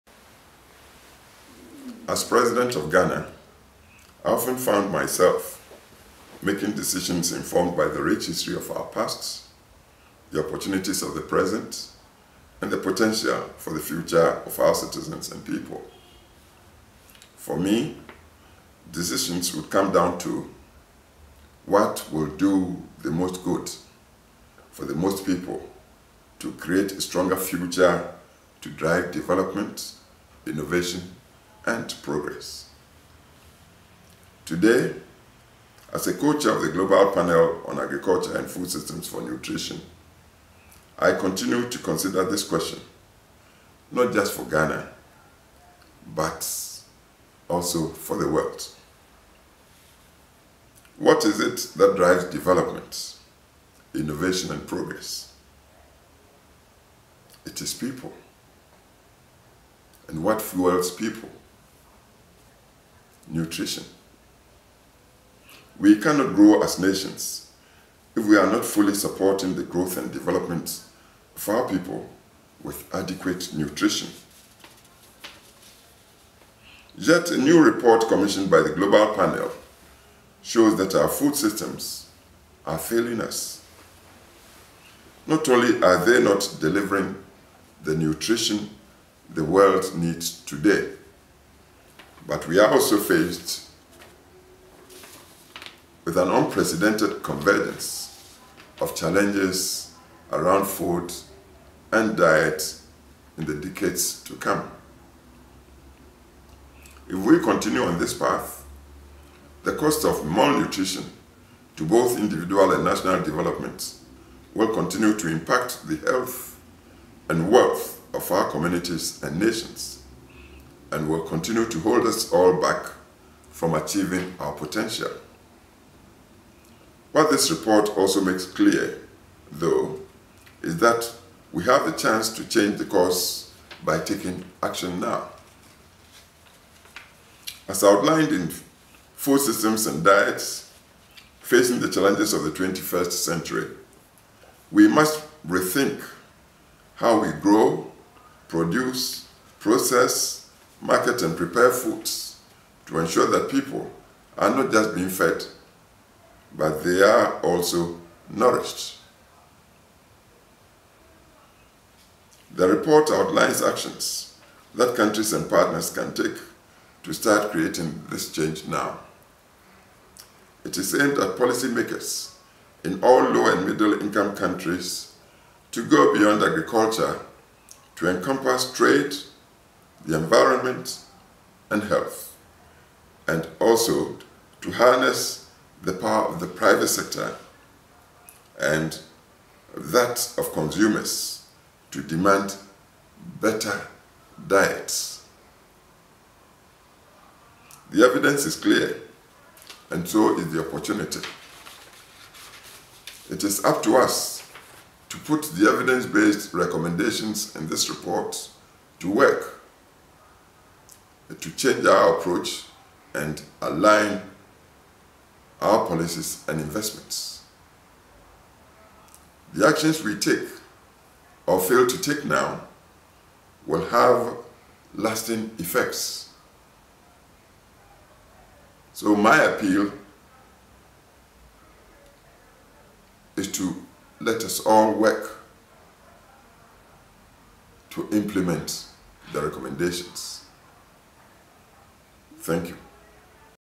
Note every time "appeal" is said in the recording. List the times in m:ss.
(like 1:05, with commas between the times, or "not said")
3:49.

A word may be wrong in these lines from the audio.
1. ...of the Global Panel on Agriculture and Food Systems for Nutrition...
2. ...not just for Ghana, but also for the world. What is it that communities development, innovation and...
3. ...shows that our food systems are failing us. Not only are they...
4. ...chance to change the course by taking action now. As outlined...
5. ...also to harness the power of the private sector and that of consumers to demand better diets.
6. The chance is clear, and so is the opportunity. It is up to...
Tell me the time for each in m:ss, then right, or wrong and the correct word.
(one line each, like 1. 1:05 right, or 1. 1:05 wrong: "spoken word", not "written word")
1. 0:36 right
2. 0:43 wrong: "drives", not "communities"
3. 1:20 right
4. 2:11 right
5. 3:03 right
6. 3:17 wrong: "evidence", not "chance".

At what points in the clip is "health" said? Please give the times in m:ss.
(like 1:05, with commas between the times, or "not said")
1:56, 3:01.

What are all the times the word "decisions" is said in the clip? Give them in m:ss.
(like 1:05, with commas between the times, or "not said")
0:06, 0:18.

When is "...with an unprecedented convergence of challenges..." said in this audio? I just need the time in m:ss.
1:36.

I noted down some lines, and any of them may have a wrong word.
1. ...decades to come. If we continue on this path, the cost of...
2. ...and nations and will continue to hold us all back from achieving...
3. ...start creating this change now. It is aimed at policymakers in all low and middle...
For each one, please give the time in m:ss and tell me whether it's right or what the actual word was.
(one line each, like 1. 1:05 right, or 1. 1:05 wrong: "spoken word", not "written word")
1. 1:43 right
2. 1:59 right
3. 2:47 right.